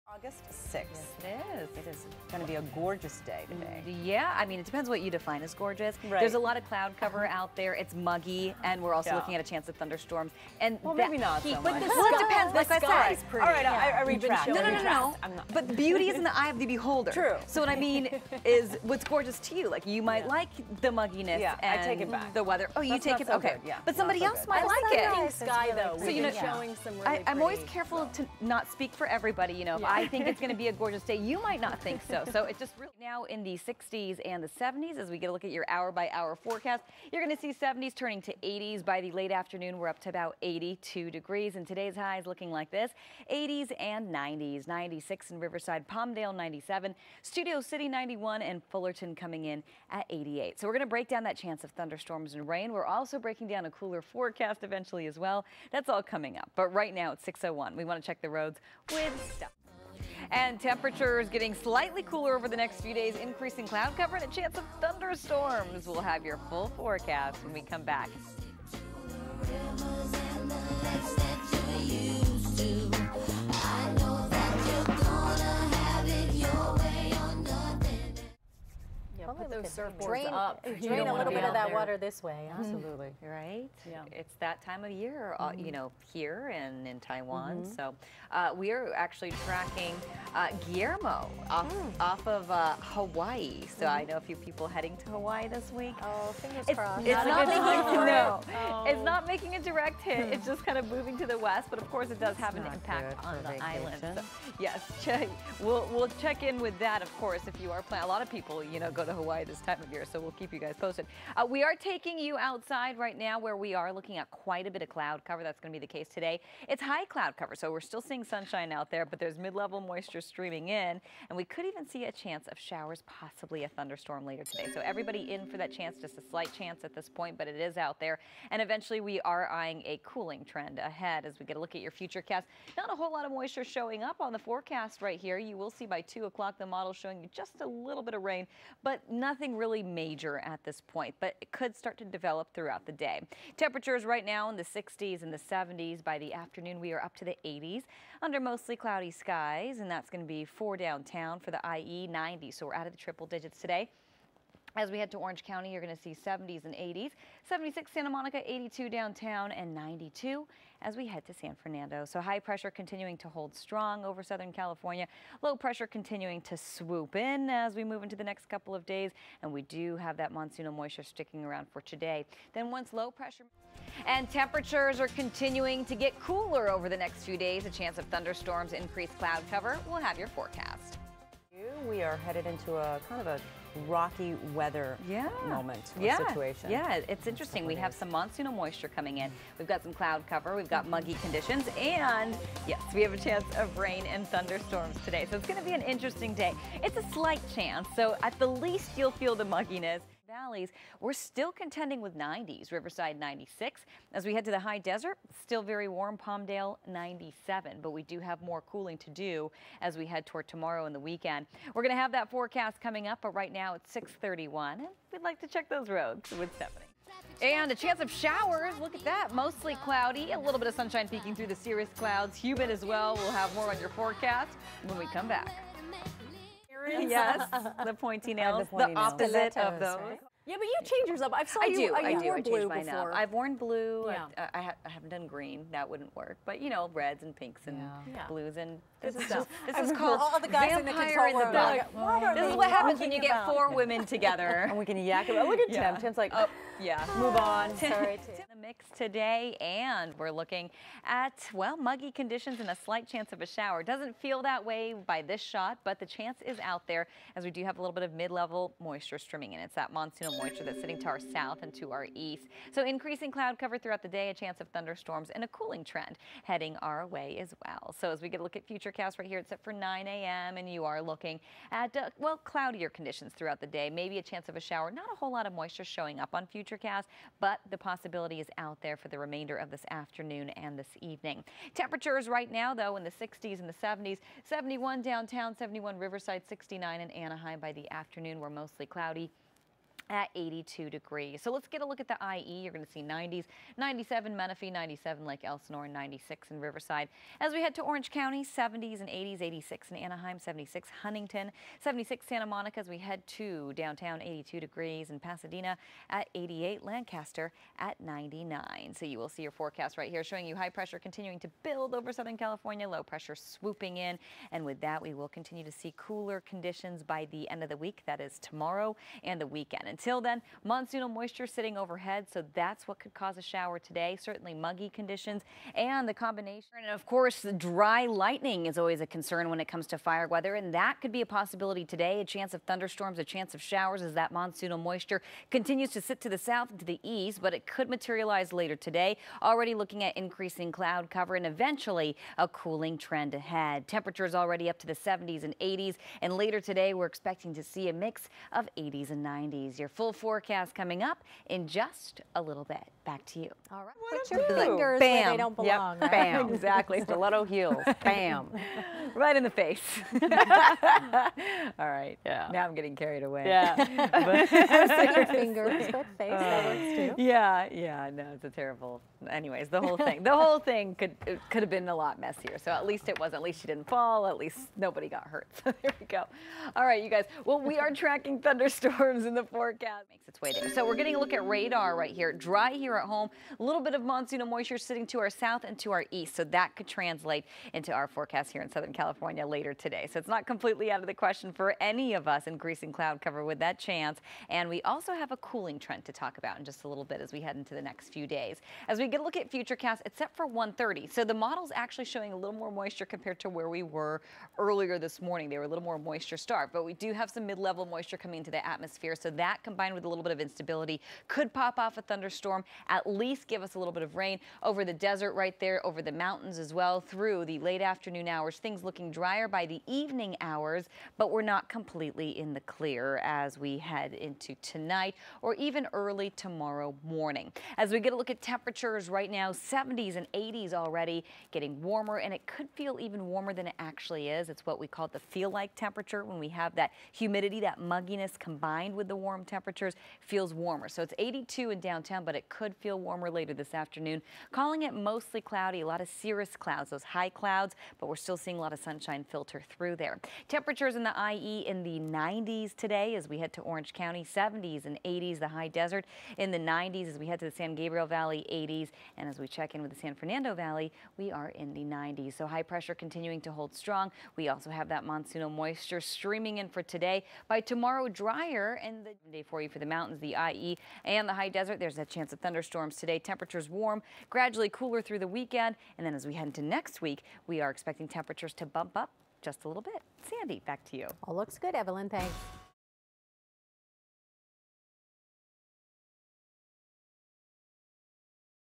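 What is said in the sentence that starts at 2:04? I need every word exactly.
So everybody in for that chance, just a slight chance at this point, but it is out there.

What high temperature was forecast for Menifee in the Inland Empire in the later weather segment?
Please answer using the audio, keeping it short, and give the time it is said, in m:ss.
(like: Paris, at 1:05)
97, at 4:53.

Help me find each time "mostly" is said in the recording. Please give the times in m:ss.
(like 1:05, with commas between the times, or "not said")
2:28, 3:39, 4:48, 7:24.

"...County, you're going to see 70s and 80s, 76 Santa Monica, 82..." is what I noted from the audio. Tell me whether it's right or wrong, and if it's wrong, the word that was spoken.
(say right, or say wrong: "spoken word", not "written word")
right.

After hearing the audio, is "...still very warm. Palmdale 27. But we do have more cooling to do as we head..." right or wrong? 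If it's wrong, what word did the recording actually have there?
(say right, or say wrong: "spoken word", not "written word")
wrong: "97", not "27".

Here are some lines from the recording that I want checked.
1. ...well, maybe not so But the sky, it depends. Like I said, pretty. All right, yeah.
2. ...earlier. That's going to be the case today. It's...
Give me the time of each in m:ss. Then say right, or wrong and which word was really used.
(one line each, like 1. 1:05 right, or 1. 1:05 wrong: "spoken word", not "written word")
1. 0:10 right
2. 1:55 wrong: "cover", not "earlier".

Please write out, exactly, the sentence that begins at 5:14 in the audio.
And with that, we will continue to see cooler conditions by the end of the week.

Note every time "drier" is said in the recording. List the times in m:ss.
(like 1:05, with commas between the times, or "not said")
6:59, 7:48.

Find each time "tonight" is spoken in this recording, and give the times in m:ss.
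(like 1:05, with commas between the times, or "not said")
7:04.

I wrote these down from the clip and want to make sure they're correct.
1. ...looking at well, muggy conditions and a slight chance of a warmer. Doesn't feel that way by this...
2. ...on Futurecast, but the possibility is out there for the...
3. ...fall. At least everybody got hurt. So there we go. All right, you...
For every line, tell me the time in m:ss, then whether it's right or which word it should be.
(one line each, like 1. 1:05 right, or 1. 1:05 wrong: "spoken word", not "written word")
1. 4:10 wrong: "shower", not "warmer"
2. 4:36 right
3. 6:13 wrong: "nobody", not "everybody".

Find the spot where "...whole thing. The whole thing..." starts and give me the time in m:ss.
6:09.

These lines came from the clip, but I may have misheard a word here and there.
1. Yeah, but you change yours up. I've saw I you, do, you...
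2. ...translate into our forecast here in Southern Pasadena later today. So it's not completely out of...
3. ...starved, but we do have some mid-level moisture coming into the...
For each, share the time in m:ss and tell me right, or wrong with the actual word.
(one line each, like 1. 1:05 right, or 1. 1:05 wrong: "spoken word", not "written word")
1. 3:50 right
2. 6:26 wrong: "California", not "Pasadena"
3. 6:46 right.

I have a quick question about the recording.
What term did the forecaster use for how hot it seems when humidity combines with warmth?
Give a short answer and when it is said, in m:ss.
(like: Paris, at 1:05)
feel-like temperature, at 7:15.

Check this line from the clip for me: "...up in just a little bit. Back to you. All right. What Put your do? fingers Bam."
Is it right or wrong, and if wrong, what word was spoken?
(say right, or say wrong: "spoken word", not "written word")
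right.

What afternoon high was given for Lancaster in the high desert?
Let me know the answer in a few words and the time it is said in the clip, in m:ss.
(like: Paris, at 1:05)
99, at 5:06.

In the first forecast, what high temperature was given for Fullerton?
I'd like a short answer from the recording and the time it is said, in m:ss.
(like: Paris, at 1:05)
88, at 0:48.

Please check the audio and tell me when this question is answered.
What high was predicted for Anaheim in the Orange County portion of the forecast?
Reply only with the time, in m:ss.
4:59.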